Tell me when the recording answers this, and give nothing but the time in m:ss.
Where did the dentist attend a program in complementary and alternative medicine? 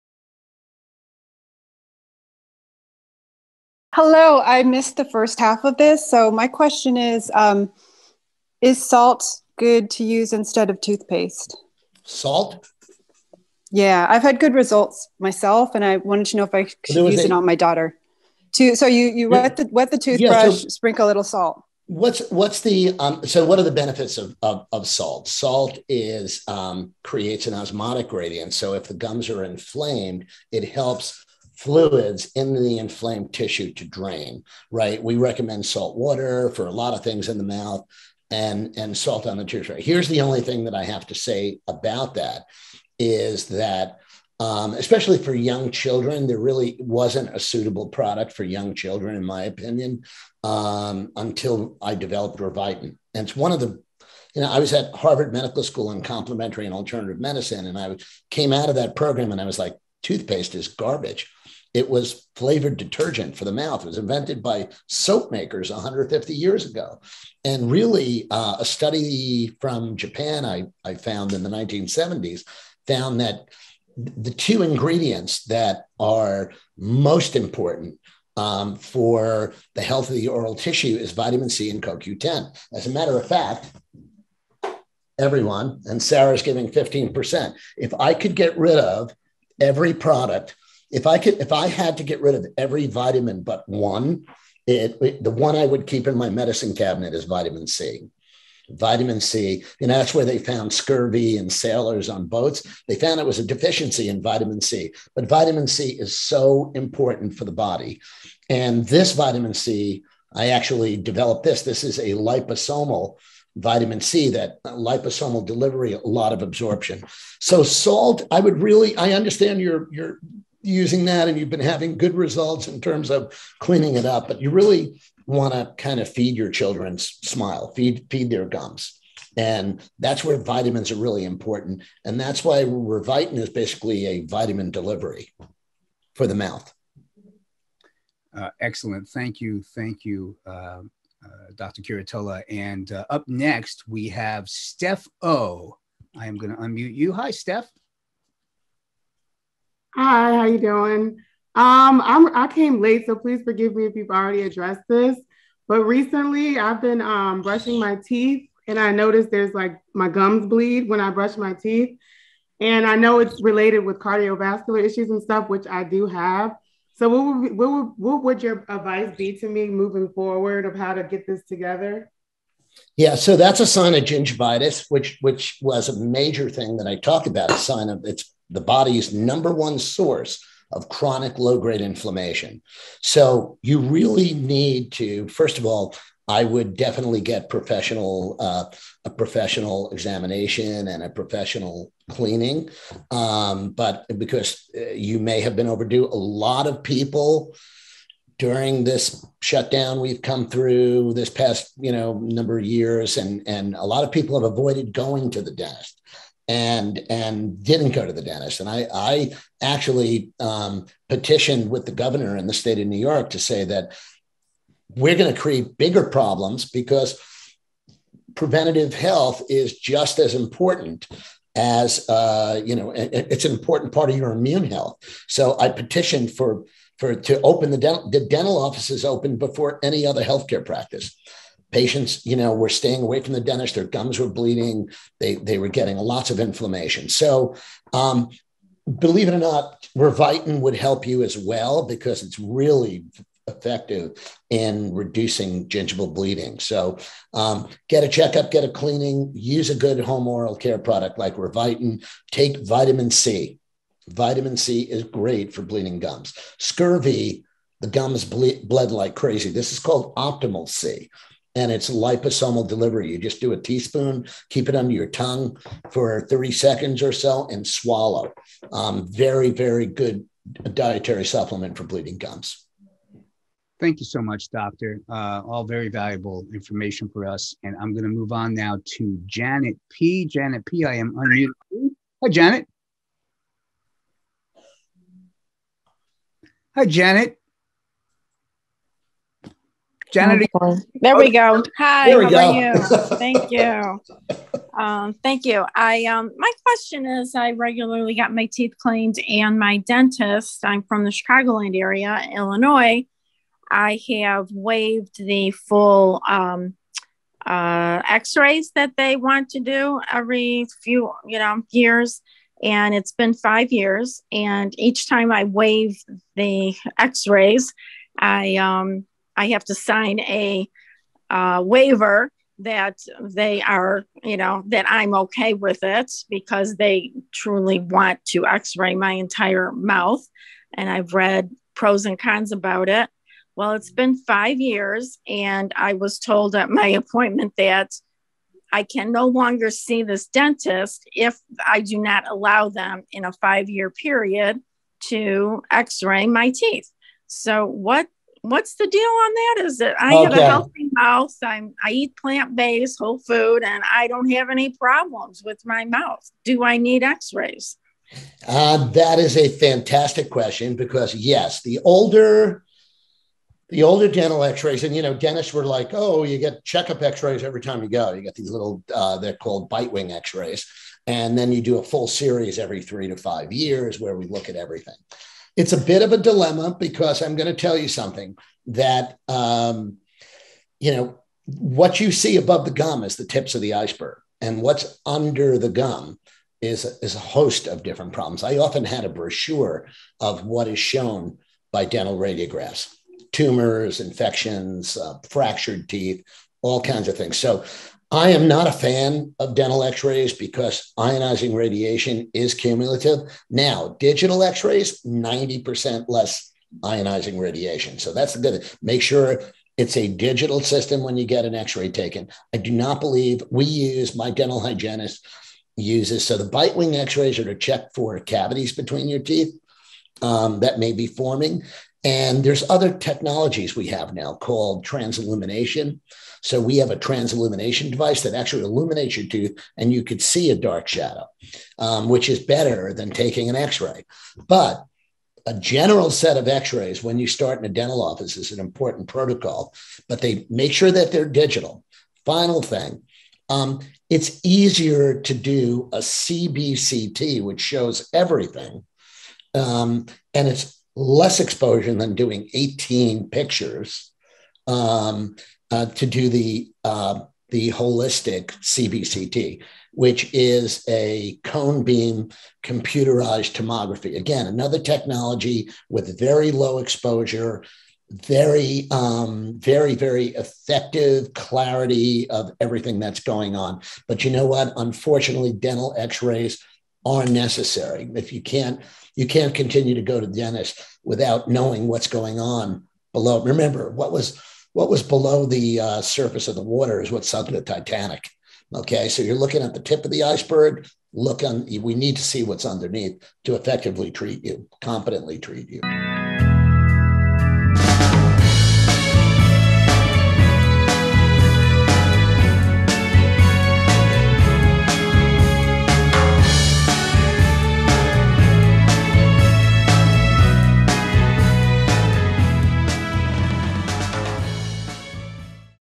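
0:54.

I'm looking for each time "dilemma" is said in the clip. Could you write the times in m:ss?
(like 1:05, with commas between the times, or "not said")
6:16.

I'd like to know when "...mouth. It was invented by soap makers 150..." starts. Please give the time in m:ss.
1:03.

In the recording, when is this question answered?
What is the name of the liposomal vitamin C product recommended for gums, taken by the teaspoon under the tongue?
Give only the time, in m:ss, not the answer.
4:20.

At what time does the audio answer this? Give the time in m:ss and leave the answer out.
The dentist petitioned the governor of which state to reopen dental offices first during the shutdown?
3:32.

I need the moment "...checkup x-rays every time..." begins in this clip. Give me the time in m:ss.
6:06.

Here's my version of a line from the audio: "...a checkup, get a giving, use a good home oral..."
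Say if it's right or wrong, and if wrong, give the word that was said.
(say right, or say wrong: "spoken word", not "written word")
wrong: "cleaning", not "giving".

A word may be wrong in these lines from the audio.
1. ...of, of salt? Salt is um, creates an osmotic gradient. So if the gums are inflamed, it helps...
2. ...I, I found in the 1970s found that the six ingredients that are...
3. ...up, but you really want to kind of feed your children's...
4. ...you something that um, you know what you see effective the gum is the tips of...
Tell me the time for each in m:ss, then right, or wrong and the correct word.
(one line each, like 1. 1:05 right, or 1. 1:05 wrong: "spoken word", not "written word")
1. 0:24 right
2. 1:10 wrong: "two", not "six"
3. 2:04 right
4. 6:17 wrong: "above", not "effective".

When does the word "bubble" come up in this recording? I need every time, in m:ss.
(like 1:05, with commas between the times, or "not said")
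not said.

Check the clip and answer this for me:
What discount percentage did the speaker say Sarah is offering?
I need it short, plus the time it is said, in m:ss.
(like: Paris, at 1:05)
15%, at 1:26.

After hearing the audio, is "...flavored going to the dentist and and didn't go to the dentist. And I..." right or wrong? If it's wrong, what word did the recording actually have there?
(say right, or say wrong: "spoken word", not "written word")
wrong: "avoided", not "flavored".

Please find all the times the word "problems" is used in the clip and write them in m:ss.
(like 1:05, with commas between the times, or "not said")
3:36, 5:54, 6:28.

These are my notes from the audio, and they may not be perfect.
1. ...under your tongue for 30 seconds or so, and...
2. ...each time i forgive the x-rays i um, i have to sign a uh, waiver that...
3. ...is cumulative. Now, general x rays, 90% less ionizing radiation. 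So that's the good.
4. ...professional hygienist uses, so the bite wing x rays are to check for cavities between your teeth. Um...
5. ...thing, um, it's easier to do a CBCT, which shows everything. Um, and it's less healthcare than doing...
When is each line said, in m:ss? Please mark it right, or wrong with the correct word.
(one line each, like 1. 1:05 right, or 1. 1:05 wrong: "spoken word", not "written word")
1. 4:24 right
2. 5:14 wrong: "waive", not "forgive"
3. 6:42 wrong: "digital", not "general"
4. 6:54 wrong: "dental", not "professional"
5. 7:22 wrong: "exposure", not "healthcare".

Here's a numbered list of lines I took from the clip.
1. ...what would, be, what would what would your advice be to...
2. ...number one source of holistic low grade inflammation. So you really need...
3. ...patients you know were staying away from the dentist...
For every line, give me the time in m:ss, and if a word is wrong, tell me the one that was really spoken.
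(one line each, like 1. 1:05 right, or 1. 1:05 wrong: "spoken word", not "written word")
1. 2:47 right
2. 2:59 wrong: "chronic", not "holistic"
3. 3:51 right.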